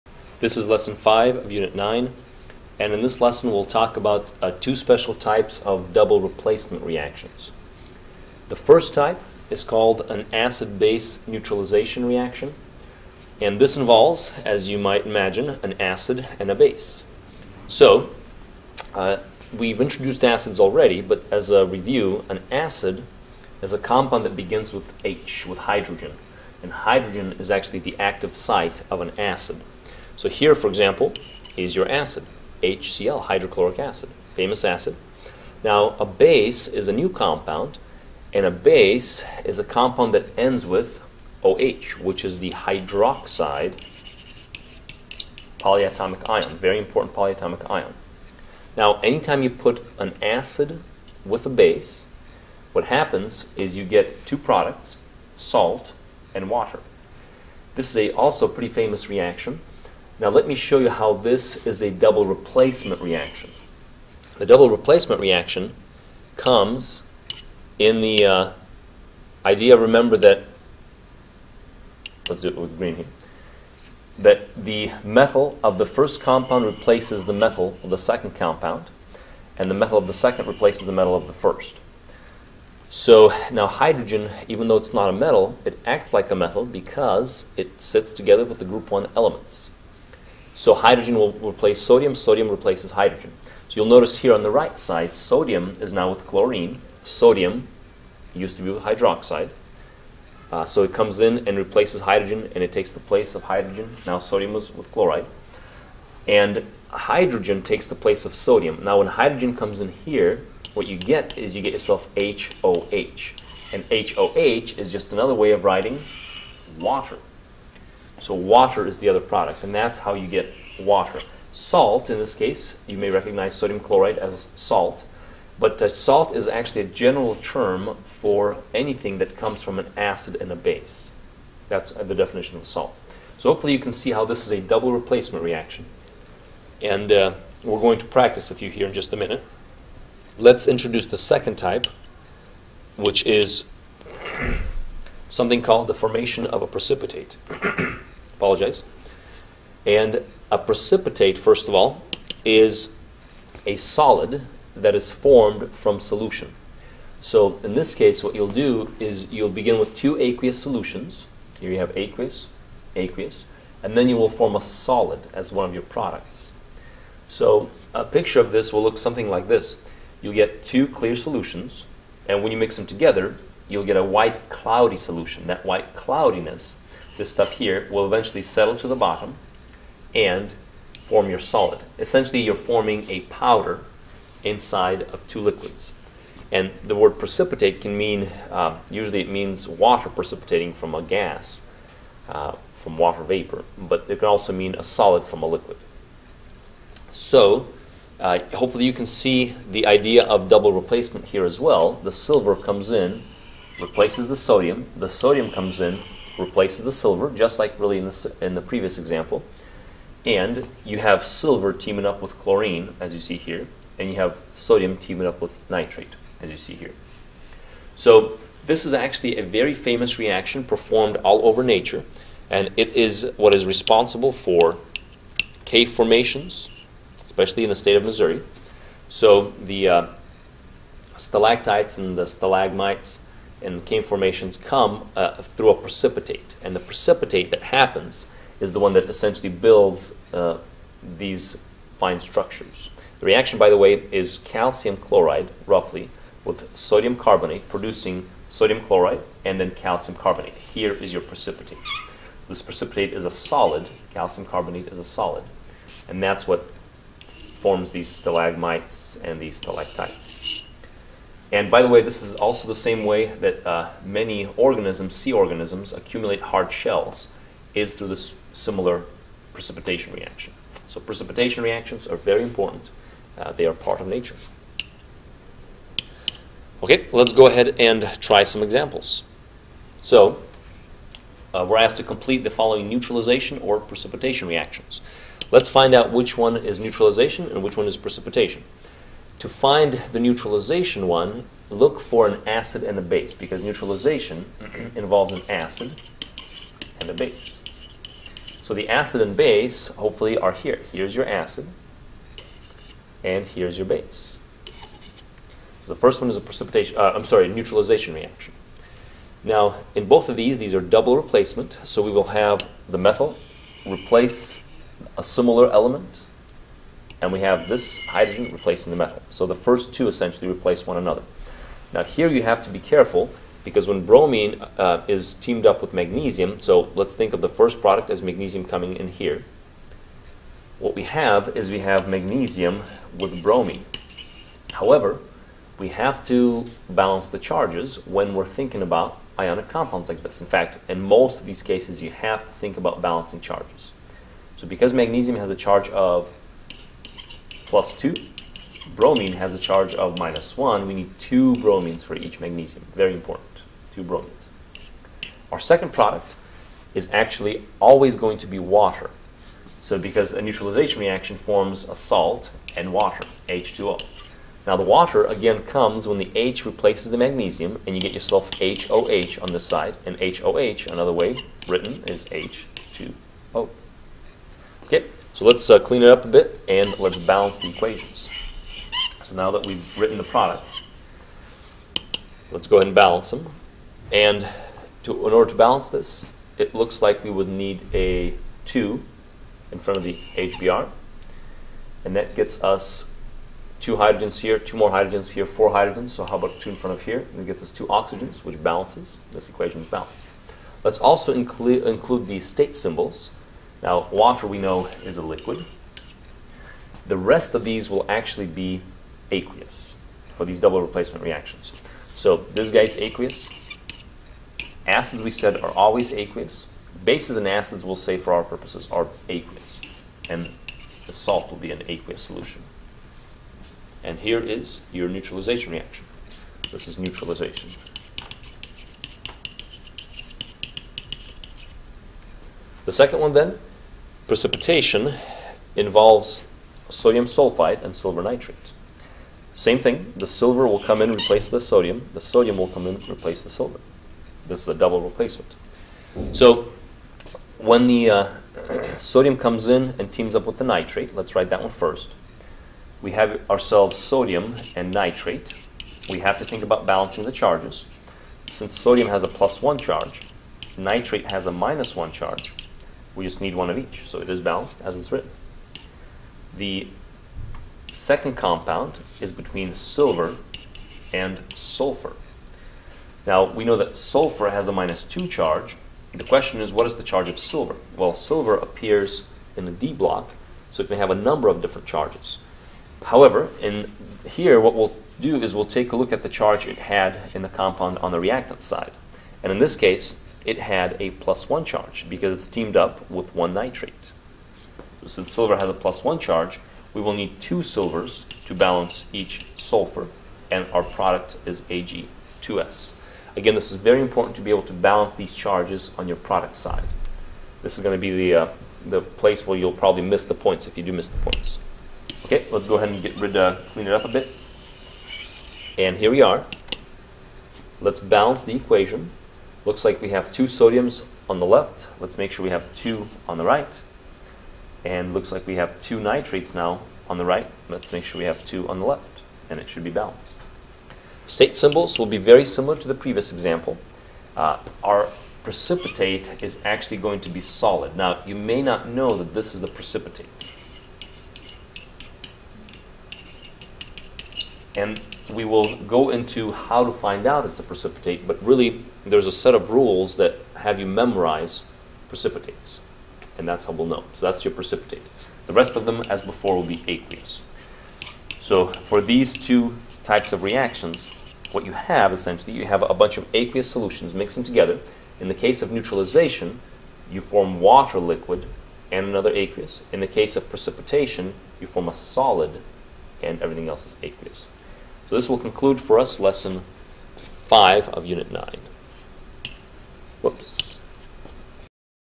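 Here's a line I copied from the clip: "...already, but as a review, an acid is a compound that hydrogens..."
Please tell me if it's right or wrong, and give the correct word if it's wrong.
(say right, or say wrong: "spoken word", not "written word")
wrong: "begins", not "hydrogens".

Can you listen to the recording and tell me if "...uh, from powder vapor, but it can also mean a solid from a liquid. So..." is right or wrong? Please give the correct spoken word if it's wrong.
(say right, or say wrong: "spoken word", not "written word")
wrong: "water", not "powder".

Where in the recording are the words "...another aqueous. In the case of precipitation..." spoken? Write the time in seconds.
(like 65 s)
569 s.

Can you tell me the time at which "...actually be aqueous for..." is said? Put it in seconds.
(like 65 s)
408 s.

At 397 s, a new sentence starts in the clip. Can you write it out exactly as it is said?
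And it gets us two oxygens, which balances.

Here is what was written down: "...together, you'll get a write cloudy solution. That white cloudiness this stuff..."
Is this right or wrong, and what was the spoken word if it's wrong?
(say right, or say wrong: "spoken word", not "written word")
wrong: "white", not "write".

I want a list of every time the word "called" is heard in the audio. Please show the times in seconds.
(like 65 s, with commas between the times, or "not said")
9 s, 145 s.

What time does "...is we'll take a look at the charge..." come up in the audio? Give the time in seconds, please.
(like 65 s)
485 s.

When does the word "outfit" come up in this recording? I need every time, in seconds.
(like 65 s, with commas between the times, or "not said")
not said.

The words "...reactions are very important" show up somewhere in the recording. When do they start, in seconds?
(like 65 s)
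271 s.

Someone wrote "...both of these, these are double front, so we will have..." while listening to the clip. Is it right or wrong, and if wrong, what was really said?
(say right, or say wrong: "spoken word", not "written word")
wrong: "replacement", not "front".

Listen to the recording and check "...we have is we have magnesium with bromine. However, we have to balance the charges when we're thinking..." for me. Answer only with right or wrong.
right.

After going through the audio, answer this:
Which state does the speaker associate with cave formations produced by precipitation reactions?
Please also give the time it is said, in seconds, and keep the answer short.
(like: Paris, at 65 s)
Missouri, at 228 s.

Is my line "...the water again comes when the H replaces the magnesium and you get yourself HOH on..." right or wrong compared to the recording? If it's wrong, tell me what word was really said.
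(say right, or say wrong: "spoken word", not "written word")
right.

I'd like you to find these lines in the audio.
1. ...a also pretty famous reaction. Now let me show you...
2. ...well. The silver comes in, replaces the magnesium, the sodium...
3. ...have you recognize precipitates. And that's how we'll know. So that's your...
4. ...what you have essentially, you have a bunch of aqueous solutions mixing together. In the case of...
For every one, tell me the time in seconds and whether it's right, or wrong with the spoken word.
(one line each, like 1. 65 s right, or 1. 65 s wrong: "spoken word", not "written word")
1. 57 s right
2. 201 s wrong: "sodium", not "magnesium"
3. 550 s wrong: "memorize", not "recognize"
4. 561 s right.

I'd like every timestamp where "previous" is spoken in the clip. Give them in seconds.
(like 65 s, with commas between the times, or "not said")
208 s, 532 s.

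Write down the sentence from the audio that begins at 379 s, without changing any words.
So now that we've written the products, let's go ahead and balance them.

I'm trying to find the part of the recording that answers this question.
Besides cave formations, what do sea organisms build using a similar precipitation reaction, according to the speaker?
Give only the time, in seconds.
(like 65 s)
266 s.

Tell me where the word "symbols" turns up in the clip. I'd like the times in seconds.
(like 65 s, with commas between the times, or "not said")
402 s, 531 s.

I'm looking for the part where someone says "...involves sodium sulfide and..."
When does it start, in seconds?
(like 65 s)
435 s.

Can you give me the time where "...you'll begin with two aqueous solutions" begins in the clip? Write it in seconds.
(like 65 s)
159 s.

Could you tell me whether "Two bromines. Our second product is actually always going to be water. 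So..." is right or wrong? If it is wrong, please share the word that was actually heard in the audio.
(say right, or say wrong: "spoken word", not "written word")
right.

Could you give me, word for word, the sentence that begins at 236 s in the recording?
And the precipitate that happens is the one that essentially builds uh, these fine structures.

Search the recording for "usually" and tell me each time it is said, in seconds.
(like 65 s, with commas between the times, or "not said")
188 s.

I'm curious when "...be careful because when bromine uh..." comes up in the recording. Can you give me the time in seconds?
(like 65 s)
322 s.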